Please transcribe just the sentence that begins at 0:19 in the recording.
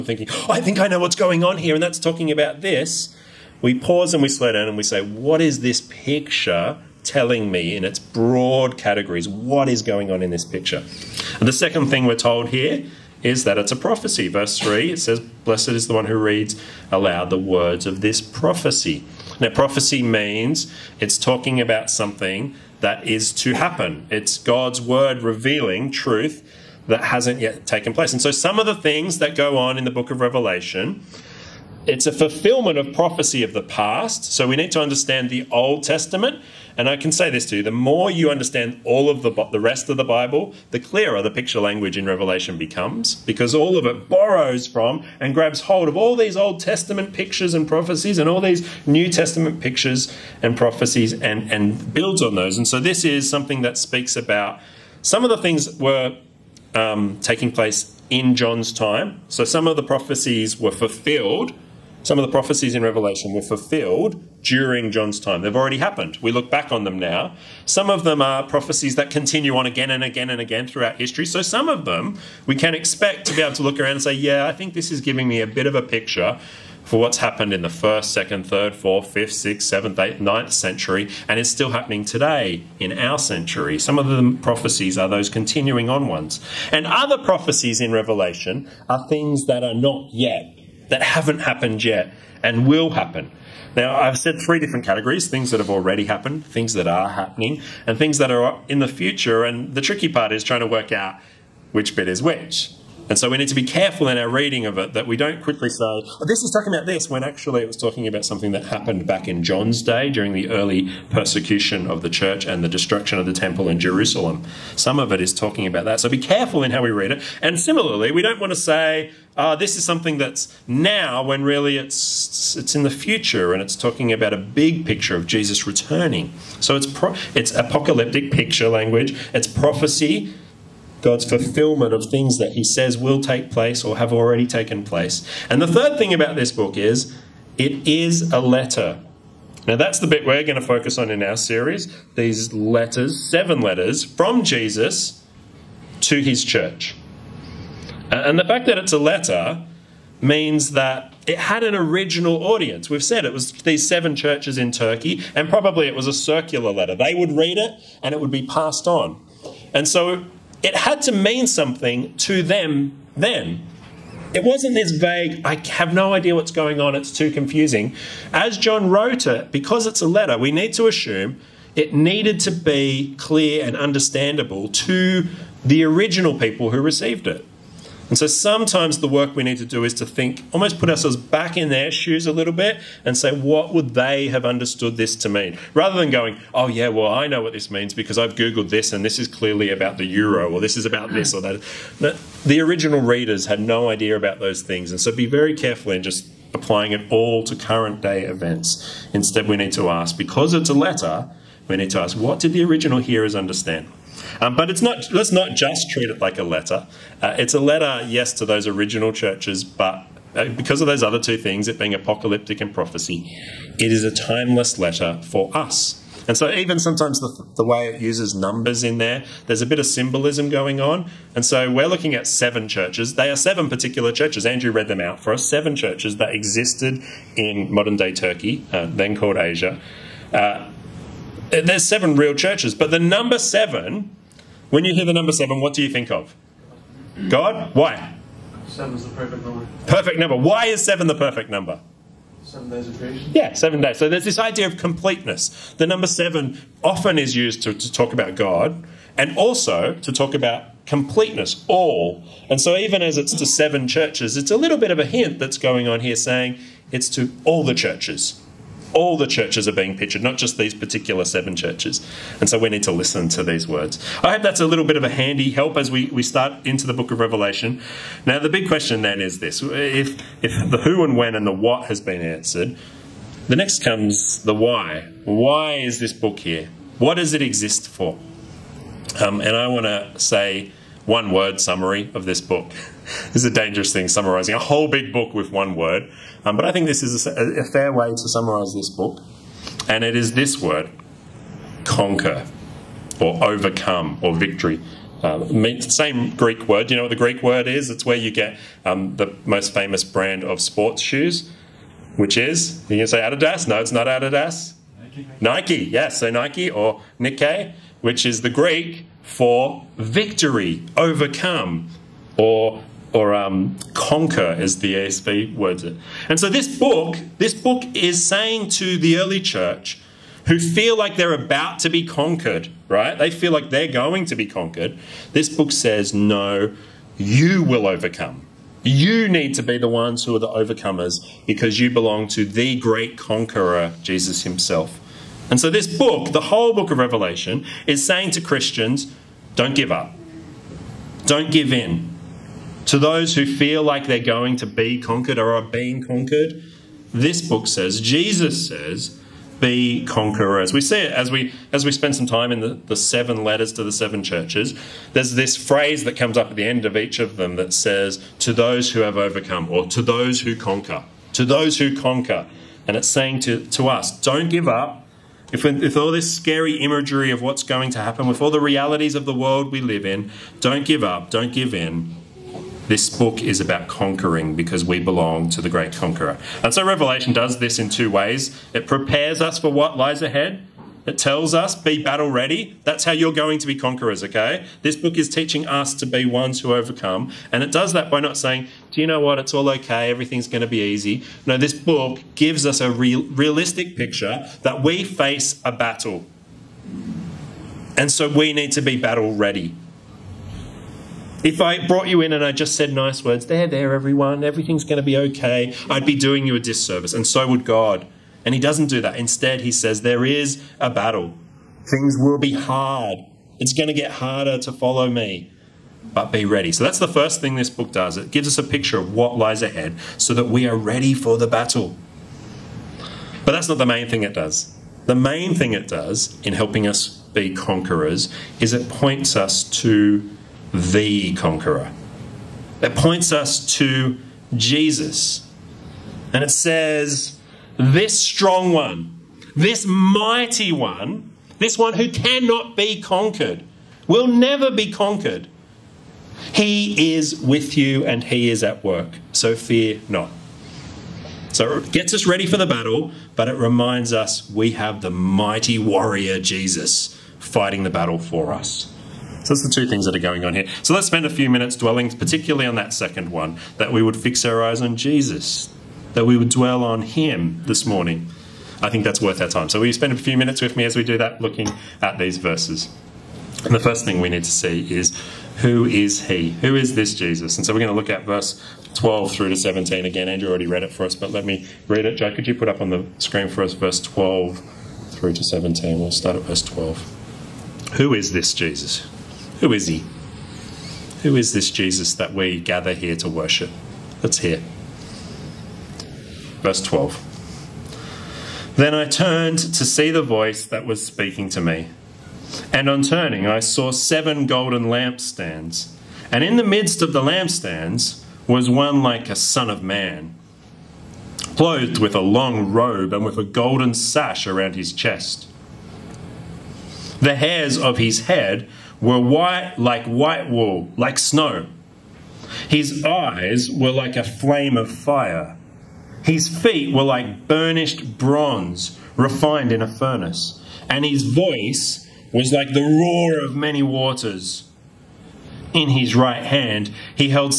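Now, prophecy means it's talking about something that is to happen.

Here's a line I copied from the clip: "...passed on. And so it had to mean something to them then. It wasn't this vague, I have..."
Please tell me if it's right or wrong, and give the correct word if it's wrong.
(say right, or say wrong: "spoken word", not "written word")
right.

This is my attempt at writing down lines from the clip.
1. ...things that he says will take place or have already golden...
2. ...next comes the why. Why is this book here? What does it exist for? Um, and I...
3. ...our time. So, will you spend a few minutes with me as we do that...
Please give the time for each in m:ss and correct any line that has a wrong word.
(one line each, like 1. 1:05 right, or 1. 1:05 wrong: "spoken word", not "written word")
1. 2:12 wrong: "taken", not "golden"
2. 4:33 right
3. 7:49 right.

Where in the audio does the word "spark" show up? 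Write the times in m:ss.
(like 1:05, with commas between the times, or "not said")
not said.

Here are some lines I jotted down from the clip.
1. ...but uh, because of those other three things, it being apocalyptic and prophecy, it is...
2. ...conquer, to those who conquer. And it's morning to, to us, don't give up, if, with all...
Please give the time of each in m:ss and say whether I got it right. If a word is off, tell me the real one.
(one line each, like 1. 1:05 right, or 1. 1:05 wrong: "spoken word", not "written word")
1. 3:29 wrong: "two", not "three"
2. 6:00 wrong: "saying", not "morning".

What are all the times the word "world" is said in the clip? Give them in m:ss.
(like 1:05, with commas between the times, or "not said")
6:09.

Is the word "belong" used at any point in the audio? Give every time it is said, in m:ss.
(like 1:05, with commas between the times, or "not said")
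5:31, 6:14.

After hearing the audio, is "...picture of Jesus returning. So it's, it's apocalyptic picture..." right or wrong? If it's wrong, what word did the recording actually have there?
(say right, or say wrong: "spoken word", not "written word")
right.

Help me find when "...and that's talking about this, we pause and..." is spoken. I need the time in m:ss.
0:01.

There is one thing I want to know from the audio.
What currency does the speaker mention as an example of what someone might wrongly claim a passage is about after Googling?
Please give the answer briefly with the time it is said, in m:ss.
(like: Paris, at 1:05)
The euro, at 3:09.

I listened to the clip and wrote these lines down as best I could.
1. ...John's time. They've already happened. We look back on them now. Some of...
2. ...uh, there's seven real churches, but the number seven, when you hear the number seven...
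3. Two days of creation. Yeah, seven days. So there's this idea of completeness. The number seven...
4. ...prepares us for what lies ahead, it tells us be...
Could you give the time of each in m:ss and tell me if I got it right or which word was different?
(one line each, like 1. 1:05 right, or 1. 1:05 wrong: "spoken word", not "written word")
1. 1:04 right
2. 3:51 right
3. 4:02 wrong: "Seven", not "Two"
4. 6:18 right.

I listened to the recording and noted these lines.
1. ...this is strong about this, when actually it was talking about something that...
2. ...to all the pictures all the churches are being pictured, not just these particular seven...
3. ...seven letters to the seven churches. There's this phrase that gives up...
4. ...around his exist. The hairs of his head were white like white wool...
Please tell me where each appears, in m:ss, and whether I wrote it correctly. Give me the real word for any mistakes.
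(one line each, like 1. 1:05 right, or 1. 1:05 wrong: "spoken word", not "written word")
1. 1:46 wrong: "talking", not "strong"
2. 4:17 wrong: "churches", not "pictures"
3. 5:52 wrong: "comes", not "gives"
4. 8:34 wrong: "chest", not "exist".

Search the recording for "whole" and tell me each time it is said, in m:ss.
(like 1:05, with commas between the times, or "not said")
4:44, 5:36.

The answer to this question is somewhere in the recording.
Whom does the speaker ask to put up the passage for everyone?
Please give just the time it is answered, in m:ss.
8:02.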